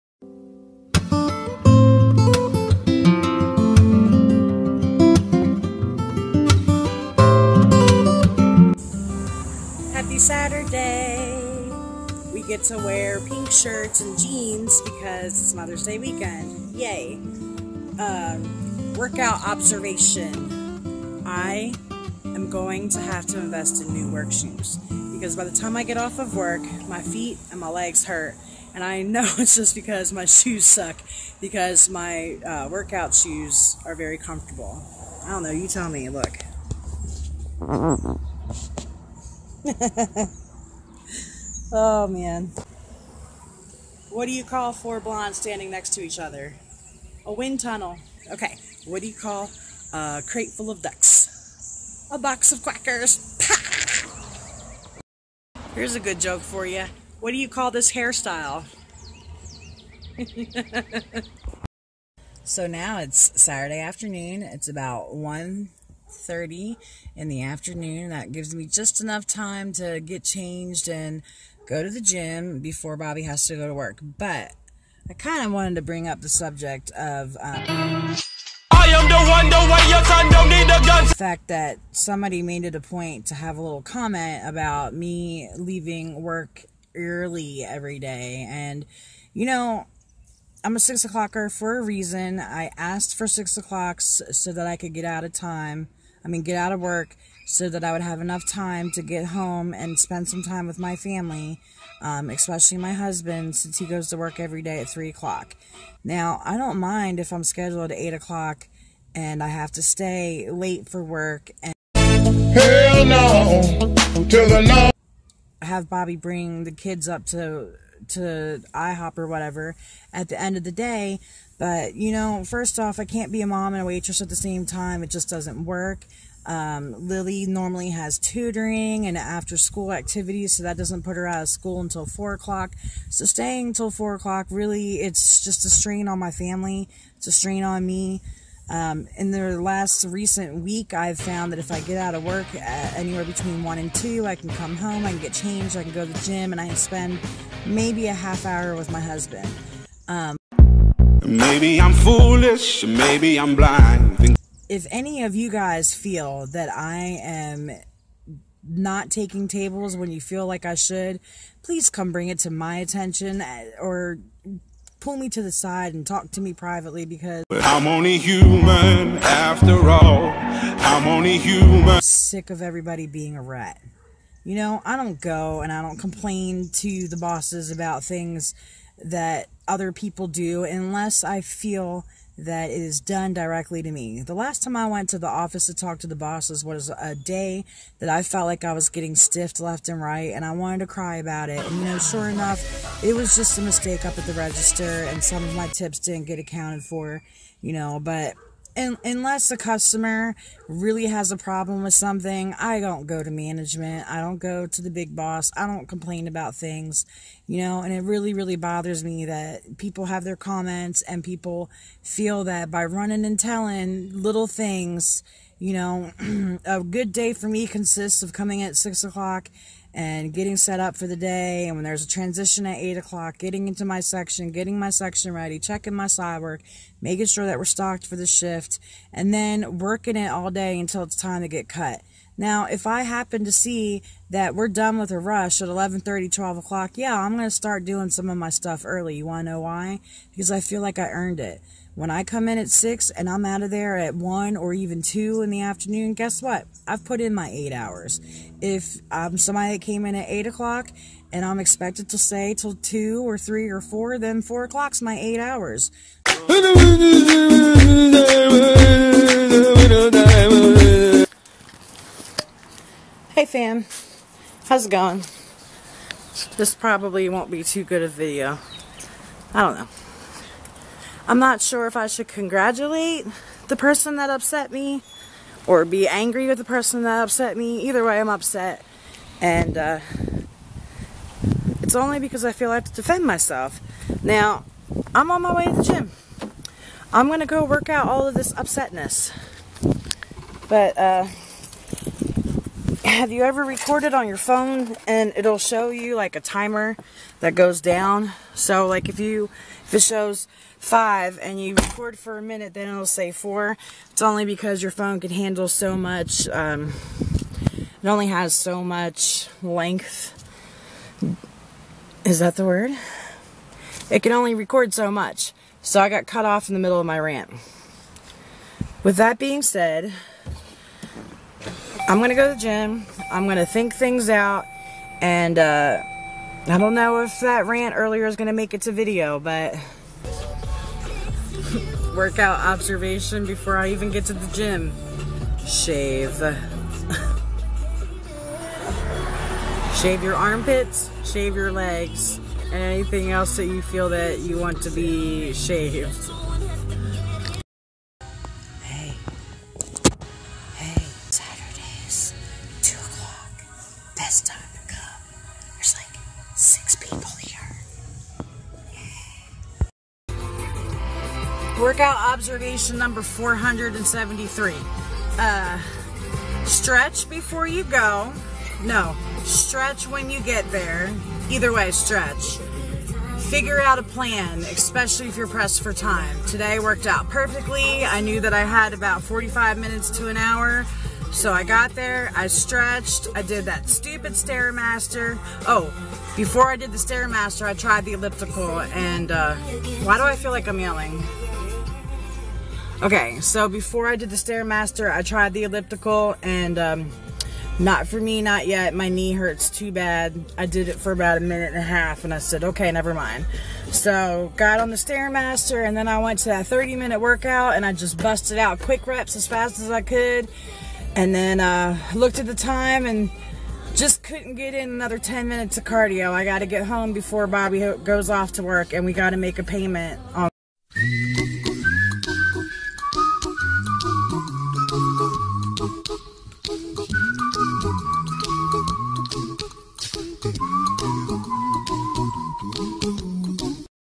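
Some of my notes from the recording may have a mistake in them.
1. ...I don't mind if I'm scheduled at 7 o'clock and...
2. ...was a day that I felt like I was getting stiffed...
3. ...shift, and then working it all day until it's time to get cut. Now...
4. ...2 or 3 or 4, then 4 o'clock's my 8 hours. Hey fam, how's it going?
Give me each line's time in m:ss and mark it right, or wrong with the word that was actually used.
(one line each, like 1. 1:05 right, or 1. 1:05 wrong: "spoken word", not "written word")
1. 1:46 wrong: "8", not "7"
2. 3:06 right
3. 3:48 right
4. 4:12 right.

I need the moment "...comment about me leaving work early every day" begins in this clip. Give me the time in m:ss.
1:23.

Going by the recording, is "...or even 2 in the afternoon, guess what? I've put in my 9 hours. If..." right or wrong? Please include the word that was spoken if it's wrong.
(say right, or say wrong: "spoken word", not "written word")
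wrong: "8", not "9".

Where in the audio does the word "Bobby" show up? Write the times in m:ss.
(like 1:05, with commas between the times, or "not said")
1:12, 1:55, 6:57.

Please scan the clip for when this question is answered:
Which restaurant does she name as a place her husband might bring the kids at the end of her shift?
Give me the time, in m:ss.
1:58.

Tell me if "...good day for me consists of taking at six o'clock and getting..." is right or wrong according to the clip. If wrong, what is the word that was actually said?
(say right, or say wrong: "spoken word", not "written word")
wrong: "coming", not "taking".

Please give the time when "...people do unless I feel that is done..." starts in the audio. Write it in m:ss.
2:59.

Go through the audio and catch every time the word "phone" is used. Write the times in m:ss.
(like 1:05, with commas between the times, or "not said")
4:54, 5:04.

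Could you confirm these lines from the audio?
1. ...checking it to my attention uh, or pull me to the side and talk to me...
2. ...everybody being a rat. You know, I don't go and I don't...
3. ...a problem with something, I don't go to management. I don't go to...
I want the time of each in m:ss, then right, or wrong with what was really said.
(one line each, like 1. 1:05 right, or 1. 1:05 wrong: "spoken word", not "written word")
1. 2:42 wrong: "bring", not "checking"
2. 2:52 right
3. 3:21 right.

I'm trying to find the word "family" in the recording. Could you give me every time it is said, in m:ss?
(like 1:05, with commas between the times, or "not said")
1:40, 2:16.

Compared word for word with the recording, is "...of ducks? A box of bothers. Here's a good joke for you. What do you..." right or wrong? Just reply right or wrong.
wrong.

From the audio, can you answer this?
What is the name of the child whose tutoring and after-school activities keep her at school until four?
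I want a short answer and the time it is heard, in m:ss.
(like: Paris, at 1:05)
Lily, at 2:07.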